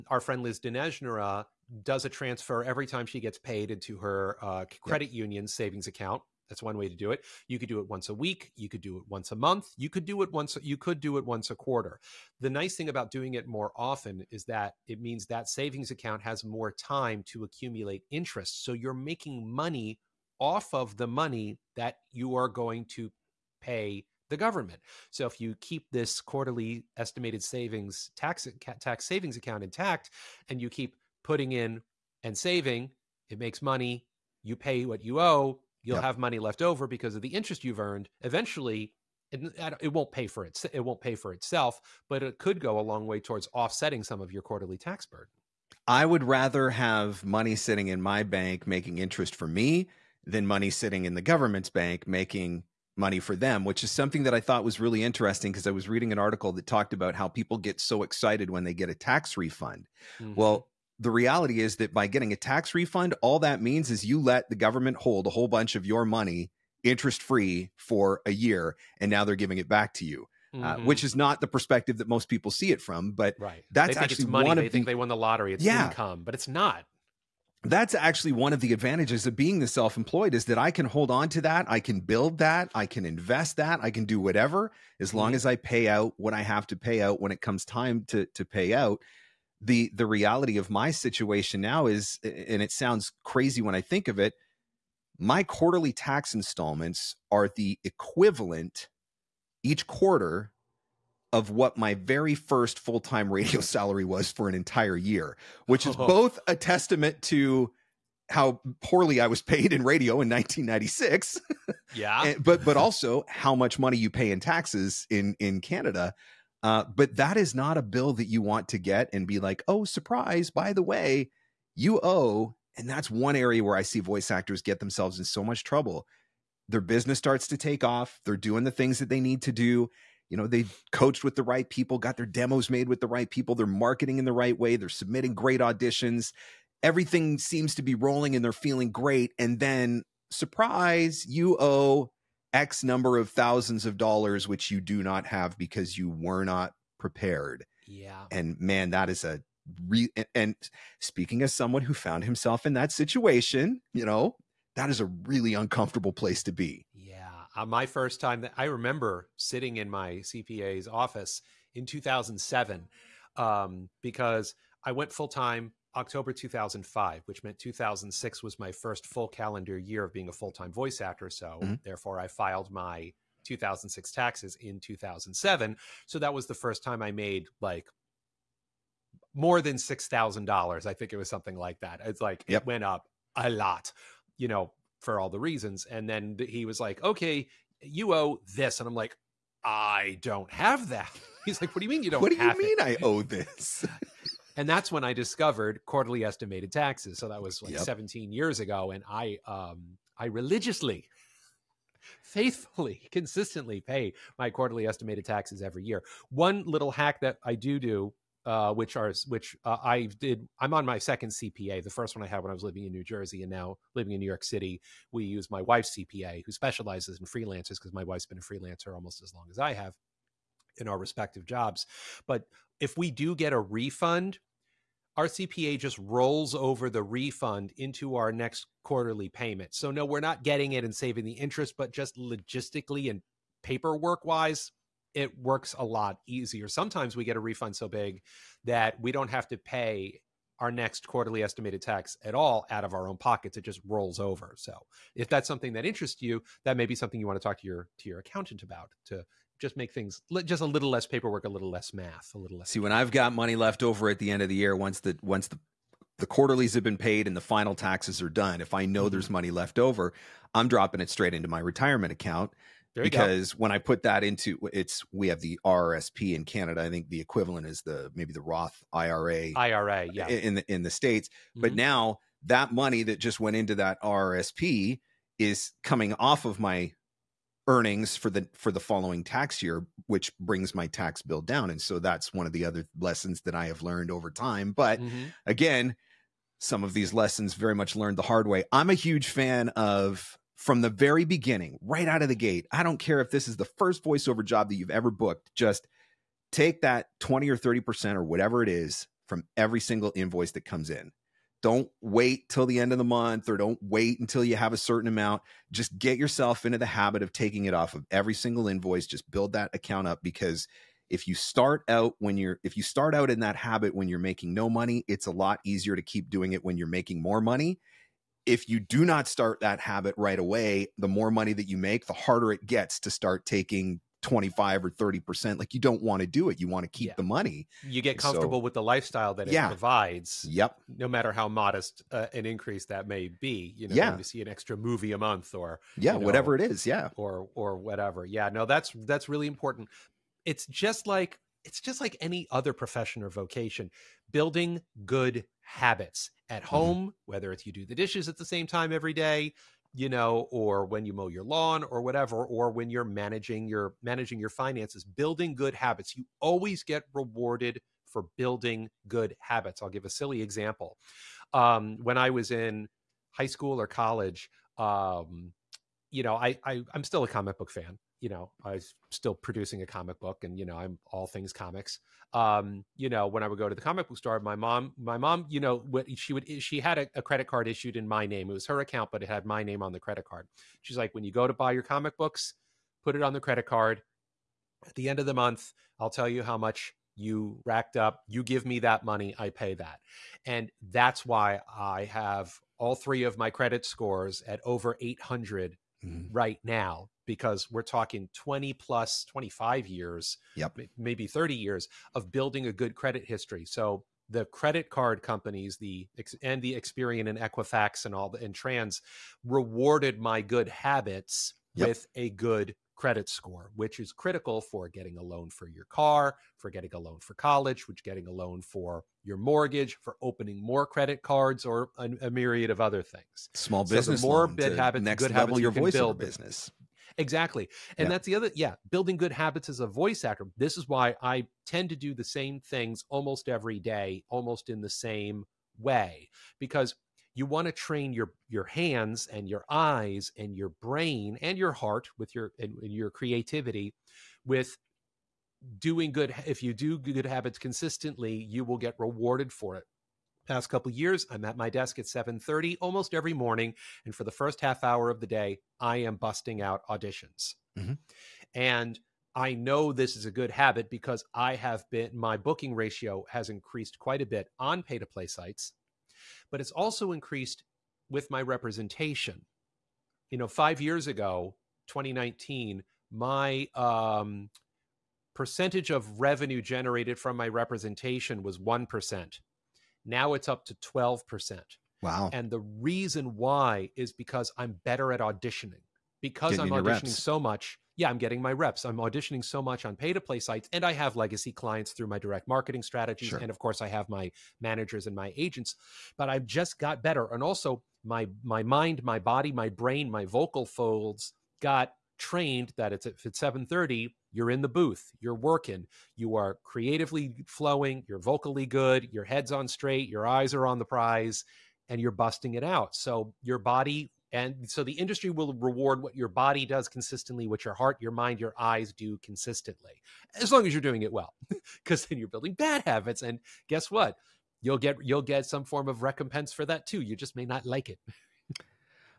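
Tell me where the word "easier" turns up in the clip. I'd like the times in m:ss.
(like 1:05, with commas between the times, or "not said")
3:56, 5:15.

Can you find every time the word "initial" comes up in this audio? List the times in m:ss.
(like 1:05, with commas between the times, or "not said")
not said.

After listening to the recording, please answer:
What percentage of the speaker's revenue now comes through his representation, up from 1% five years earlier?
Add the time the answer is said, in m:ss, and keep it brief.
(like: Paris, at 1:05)
12%, at 8:00.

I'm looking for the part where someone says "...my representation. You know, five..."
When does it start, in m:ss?
7:48.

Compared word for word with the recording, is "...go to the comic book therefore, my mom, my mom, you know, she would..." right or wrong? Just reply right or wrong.
wrong.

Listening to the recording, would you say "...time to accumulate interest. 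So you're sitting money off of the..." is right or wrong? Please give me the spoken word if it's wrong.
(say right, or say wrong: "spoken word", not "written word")
wrong: "making", not "sitting".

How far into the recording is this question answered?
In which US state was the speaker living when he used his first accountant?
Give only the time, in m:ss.
3:32.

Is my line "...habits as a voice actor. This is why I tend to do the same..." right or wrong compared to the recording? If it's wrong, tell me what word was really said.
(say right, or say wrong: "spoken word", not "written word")
right.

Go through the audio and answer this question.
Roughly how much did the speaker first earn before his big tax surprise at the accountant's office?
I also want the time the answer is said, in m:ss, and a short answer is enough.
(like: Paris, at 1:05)
$6,000, at 2:59.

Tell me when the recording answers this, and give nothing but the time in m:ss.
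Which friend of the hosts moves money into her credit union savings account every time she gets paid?
0:00.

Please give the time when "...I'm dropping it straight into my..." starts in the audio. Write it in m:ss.
4:20.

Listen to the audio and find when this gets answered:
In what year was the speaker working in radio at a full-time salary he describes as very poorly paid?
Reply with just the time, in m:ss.
1:50.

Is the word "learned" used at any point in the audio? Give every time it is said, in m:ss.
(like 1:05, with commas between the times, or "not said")
4:43, 4:47.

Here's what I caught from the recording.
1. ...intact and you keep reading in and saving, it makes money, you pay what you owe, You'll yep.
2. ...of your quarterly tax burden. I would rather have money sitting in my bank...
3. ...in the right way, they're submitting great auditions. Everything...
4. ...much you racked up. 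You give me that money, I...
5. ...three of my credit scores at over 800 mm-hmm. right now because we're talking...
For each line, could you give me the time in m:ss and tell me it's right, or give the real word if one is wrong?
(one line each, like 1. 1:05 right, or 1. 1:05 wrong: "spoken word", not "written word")
1. 0:29 wrong: "putting", not "reading"
2. 0:44 right
3. 2:14 right
4. 6:26 right
5. 6:32 right.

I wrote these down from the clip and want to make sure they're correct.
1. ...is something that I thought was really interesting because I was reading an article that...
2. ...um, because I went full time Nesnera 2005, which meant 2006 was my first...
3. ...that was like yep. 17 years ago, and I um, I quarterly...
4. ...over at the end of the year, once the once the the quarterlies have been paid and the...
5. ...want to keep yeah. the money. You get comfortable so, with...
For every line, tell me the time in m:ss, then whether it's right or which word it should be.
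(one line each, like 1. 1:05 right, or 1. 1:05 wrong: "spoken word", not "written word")
1. 0:53 right
2. 2:43 wrong: "October", not "Nesnera"
3. 3:17 wrong: "religiously", not "quarterly"
4. 4:13 right
5. 5:26 right.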